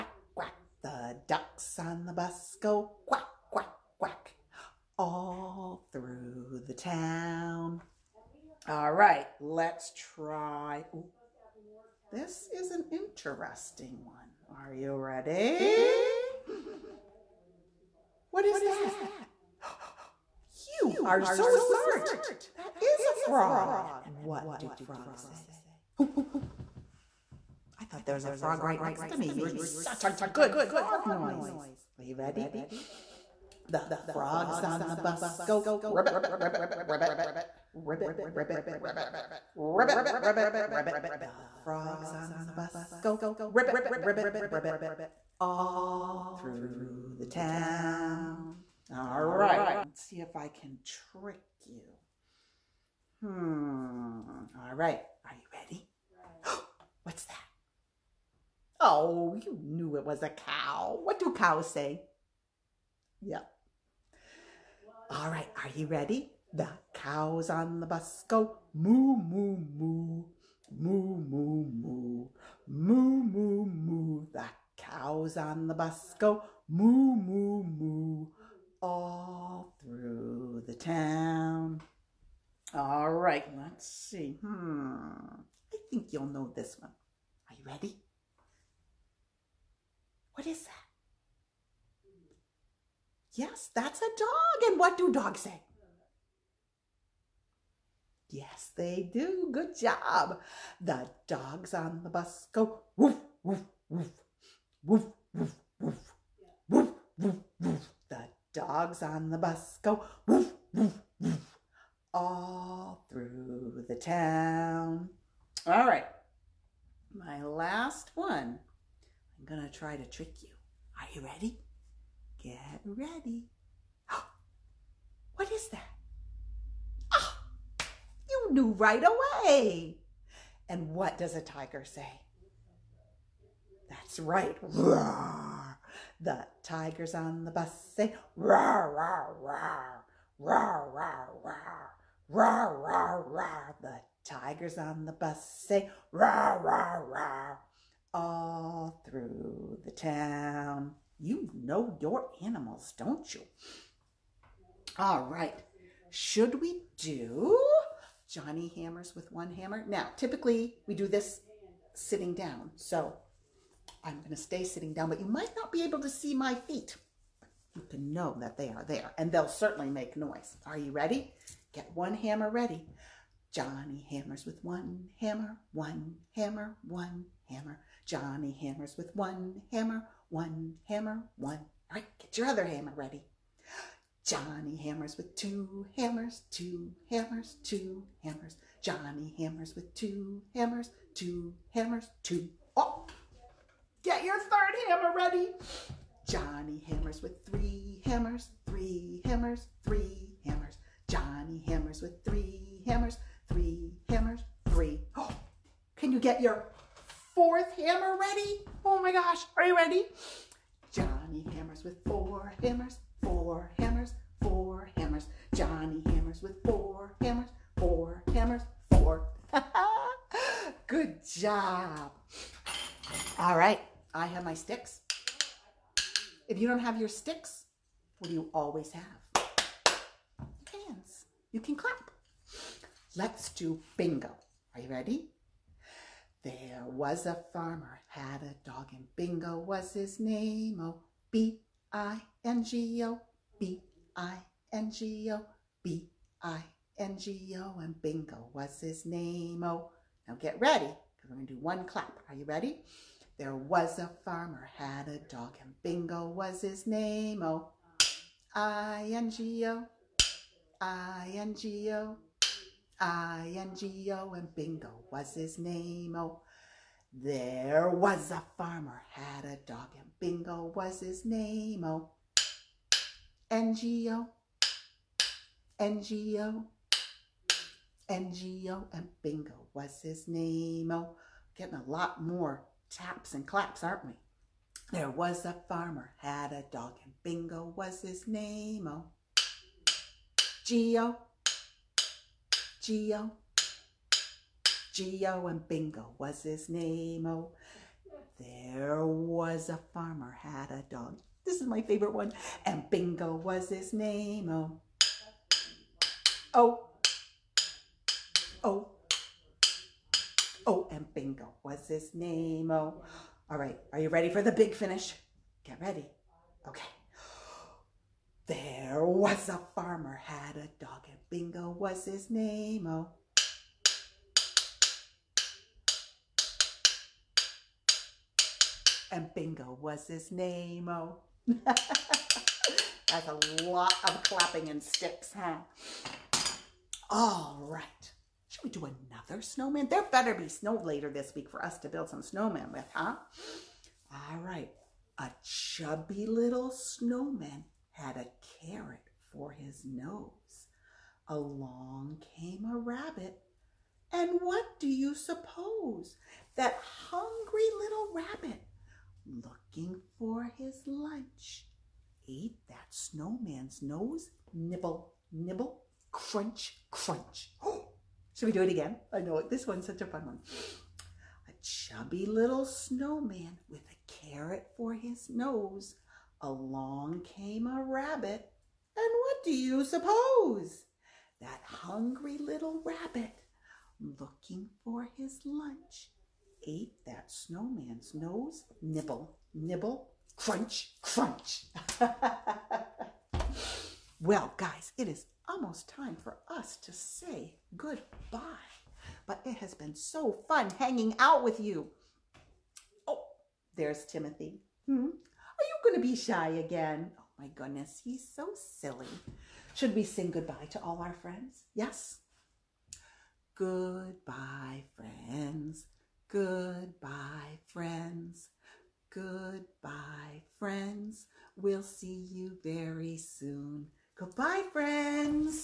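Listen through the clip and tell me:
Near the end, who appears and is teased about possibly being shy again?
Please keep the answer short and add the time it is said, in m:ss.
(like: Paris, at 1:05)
Timothy, at 6:44.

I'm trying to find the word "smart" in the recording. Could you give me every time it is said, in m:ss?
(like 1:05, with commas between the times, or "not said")
0:21.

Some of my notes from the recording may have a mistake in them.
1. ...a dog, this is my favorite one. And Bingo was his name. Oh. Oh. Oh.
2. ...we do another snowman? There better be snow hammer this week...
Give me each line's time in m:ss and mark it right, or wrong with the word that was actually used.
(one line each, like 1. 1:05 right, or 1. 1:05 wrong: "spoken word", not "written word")
1. 5:00 right
2. 5:38 wrong: "later", not "hammer".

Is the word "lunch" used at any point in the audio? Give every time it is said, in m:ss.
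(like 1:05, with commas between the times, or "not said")
6:00, 6:25.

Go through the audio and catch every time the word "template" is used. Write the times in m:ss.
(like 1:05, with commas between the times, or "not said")
not said.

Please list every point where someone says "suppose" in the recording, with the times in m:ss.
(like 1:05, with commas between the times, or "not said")
5:55, 6:19.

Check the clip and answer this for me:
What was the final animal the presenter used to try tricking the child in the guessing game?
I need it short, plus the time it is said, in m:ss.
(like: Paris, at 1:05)
Tiger, at 2:11.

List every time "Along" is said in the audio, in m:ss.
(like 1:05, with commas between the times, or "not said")
5:51, 6:16.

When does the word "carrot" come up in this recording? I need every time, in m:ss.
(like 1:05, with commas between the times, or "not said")
5:48, 6:14.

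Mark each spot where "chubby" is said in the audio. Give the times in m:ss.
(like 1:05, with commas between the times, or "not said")
5:45, 6:11.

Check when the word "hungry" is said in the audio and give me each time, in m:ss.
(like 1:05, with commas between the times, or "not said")
5:57, 6:21.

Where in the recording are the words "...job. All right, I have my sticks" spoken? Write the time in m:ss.
3:41.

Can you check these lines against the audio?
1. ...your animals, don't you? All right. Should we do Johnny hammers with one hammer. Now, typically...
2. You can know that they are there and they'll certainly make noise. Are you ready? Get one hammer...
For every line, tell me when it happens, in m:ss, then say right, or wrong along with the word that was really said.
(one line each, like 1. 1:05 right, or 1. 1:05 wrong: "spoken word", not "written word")
1. 2:32 right
2. 2:47 right.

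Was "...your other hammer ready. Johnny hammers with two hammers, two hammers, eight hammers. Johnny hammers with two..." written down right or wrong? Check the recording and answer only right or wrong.
wrong.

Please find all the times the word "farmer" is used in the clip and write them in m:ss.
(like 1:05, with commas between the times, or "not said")
3:57, 4:14, 4:28, 4:45, 4:59, 5:19.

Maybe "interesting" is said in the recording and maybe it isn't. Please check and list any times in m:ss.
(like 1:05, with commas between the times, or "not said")
0:12.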